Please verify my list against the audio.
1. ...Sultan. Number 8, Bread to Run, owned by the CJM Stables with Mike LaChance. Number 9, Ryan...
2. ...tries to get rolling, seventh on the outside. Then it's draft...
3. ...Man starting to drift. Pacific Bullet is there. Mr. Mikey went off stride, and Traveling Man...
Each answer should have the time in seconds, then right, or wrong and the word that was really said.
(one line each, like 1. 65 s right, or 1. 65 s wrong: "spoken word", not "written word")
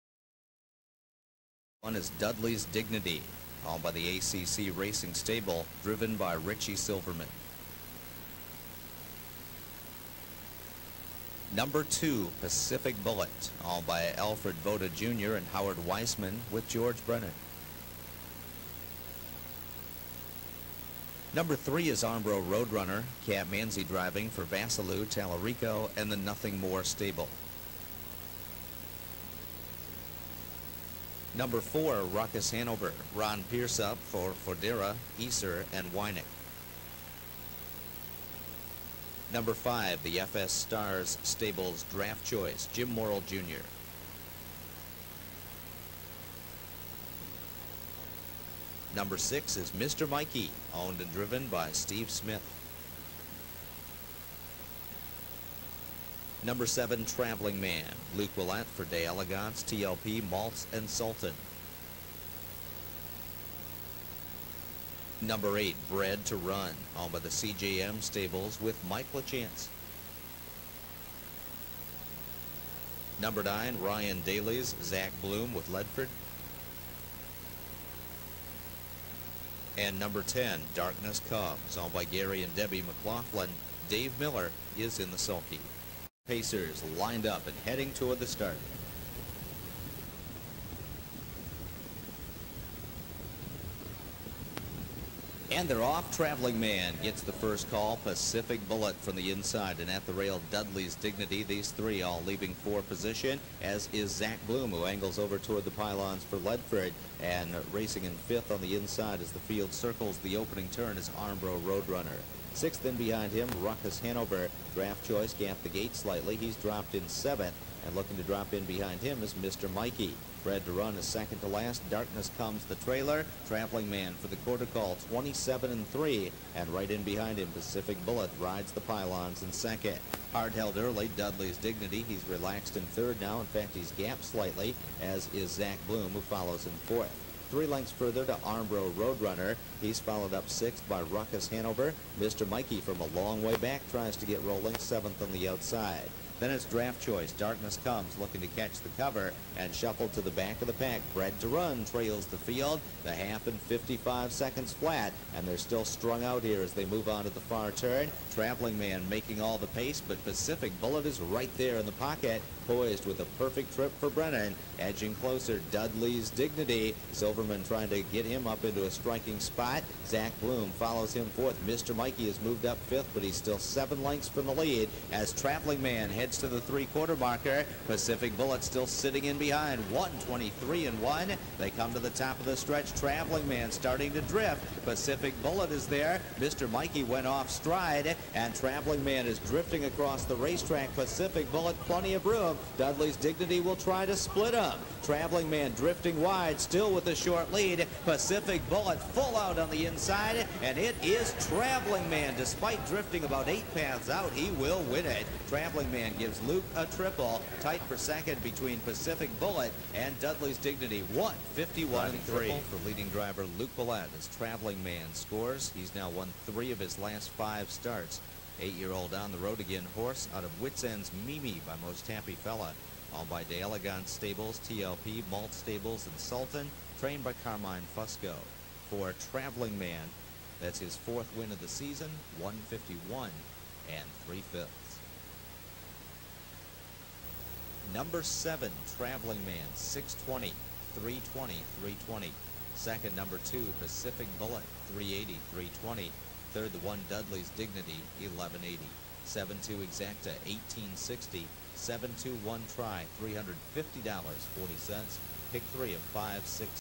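1. 60 s right
2. 143 s right
3. 183 s right.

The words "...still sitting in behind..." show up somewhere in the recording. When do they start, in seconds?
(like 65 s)
178 s.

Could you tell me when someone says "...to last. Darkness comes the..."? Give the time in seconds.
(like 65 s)
121 s.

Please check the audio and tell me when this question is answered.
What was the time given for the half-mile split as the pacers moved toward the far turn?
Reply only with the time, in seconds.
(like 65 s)
153 s.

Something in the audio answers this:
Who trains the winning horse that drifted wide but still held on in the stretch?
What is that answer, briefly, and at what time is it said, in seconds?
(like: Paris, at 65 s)
Carmine Fusco, at 227 s.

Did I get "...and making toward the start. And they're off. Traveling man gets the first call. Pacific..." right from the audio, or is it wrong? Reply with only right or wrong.
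wrong.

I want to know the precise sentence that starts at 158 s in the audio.
Traveling Man making all the pace, but Pacific Bullet is right there in the pocket, poised with a perfect trip for Brennan.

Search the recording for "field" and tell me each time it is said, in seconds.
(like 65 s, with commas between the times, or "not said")
109 s, 152 s.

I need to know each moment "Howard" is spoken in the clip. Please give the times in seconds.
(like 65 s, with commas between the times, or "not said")
15 s.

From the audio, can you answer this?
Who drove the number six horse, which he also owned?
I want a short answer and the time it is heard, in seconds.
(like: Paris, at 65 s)
Steve Smith, at 51 s.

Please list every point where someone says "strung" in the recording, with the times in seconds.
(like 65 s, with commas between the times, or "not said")
155 s.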